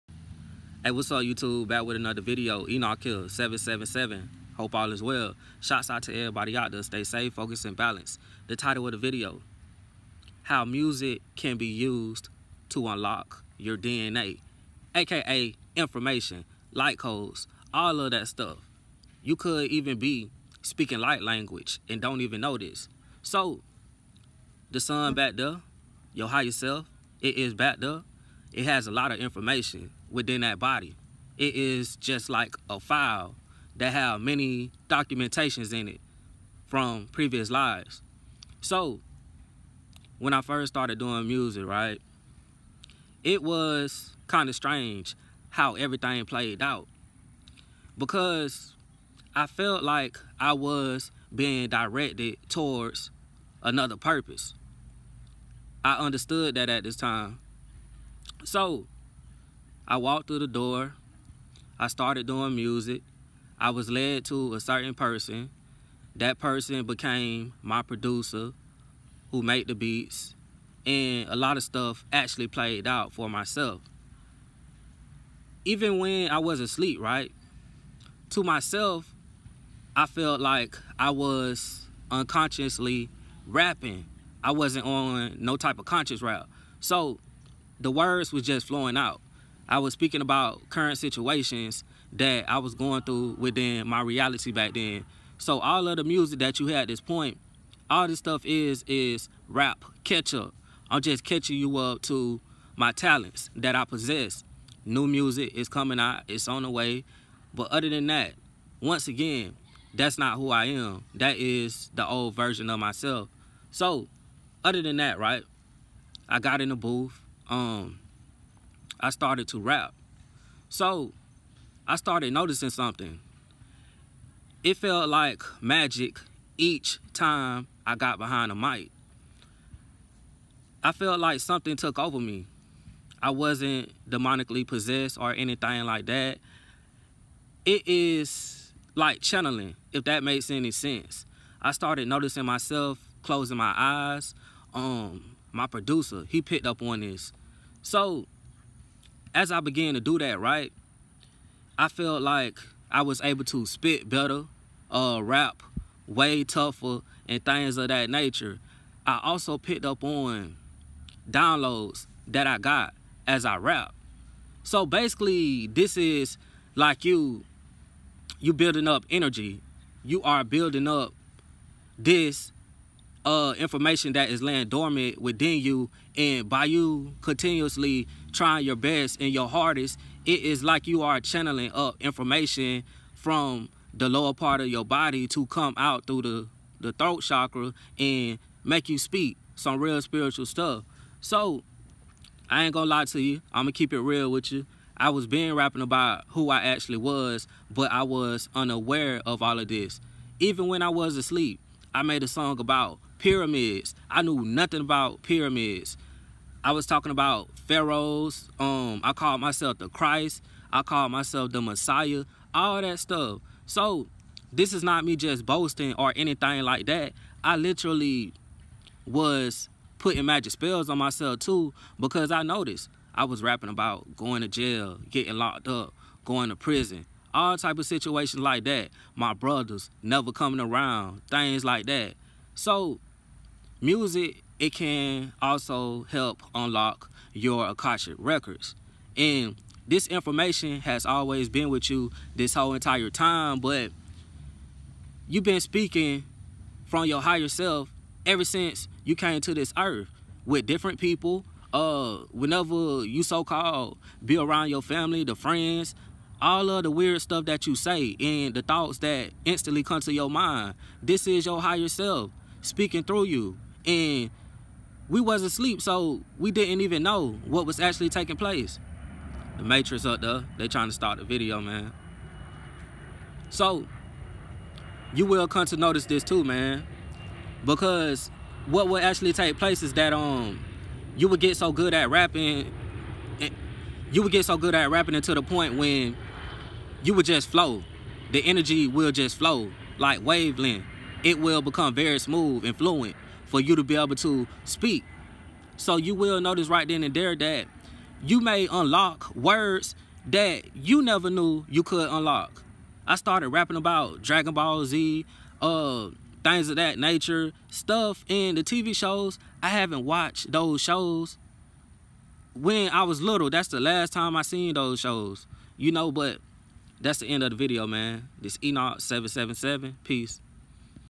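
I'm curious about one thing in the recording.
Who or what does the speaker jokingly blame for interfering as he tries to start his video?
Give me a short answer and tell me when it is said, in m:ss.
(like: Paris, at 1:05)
The Matrix, at 4:29.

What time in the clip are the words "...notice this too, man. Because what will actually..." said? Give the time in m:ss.
4:35.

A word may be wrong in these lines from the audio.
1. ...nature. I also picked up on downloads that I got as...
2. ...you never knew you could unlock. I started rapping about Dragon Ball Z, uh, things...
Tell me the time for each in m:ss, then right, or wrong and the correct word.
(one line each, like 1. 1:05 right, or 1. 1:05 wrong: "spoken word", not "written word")
1. 2:38 right
2. 5:00 right.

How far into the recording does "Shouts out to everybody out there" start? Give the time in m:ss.
0:05.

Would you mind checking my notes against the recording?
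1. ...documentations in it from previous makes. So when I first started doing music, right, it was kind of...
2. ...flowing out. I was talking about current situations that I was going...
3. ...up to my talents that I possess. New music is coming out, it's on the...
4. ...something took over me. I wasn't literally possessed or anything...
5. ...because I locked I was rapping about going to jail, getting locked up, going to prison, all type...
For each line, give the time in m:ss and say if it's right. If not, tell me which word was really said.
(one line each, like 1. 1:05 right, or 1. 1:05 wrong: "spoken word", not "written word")
1. 0:34 wrong: "lives", not "makes"
2. 1:28 wrong: "speaking", not "talking"
3. 1:41 right
4. 2:11 wrong: "demonically", not "literally"
5. 3:41 wrong: "noticed", not "locked".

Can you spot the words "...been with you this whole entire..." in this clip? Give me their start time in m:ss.
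4:01.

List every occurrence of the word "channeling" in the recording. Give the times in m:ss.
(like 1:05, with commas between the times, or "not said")
2:19, 3:01.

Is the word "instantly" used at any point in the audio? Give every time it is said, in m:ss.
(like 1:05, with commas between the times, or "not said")
4:19.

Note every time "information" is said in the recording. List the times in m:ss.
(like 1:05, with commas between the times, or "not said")
0:15, 0:29, 2:53, 3:01, 4:00.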